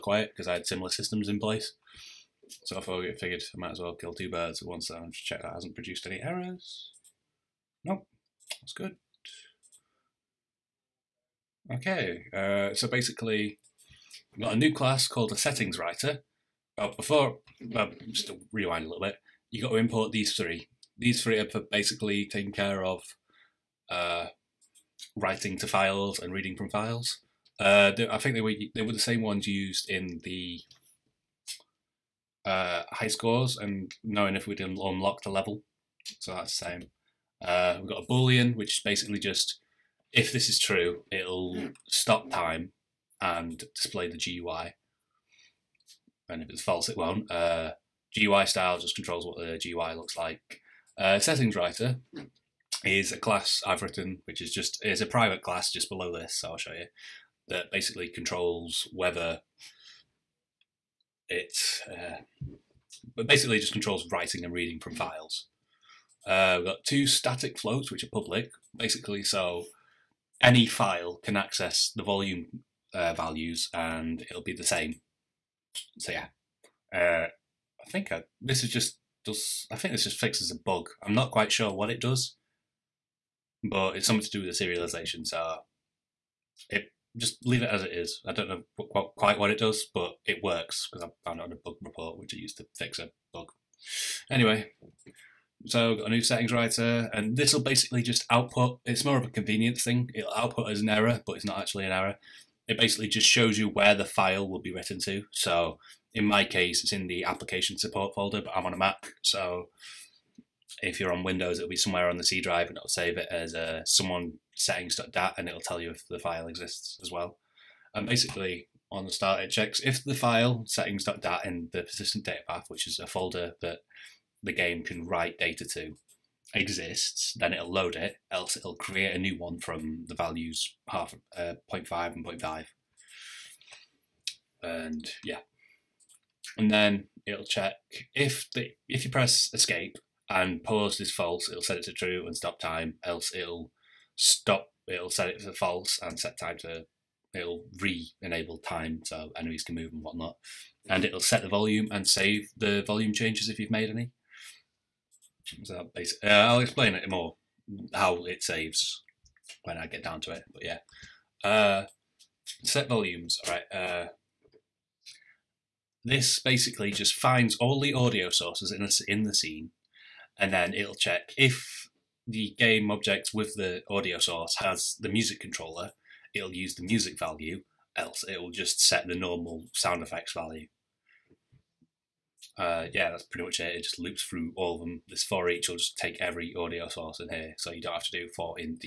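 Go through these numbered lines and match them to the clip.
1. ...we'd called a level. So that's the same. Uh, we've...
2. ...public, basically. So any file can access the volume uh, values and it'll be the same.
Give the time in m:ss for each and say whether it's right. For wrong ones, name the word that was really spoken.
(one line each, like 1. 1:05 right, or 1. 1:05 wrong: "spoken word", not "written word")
1. 0:34 wrong: "unlocked", not "called"
2. 1:08 right.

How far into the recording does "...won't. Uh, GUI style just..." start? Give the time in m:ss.
0:46.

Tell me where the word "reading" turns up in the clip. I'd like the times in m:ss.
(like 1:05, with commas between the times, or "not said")
0:26, 1:04.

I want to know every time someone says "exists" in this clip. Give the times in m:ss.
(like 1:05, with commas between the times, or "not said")
1:56, 2:06.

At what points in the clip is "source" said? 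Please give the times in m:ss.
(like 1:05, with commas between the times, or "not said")
2:48, 2:54, 3:06.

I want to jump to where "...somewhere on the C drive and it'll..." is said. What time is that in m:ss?
1:51.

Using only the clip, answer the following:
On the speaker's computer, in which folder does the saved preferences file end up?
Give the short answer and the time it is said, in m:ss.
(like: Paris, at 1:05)
application support folder, at 1:47.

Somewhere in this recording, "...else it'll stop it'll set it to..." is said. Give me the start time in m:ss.
2:23.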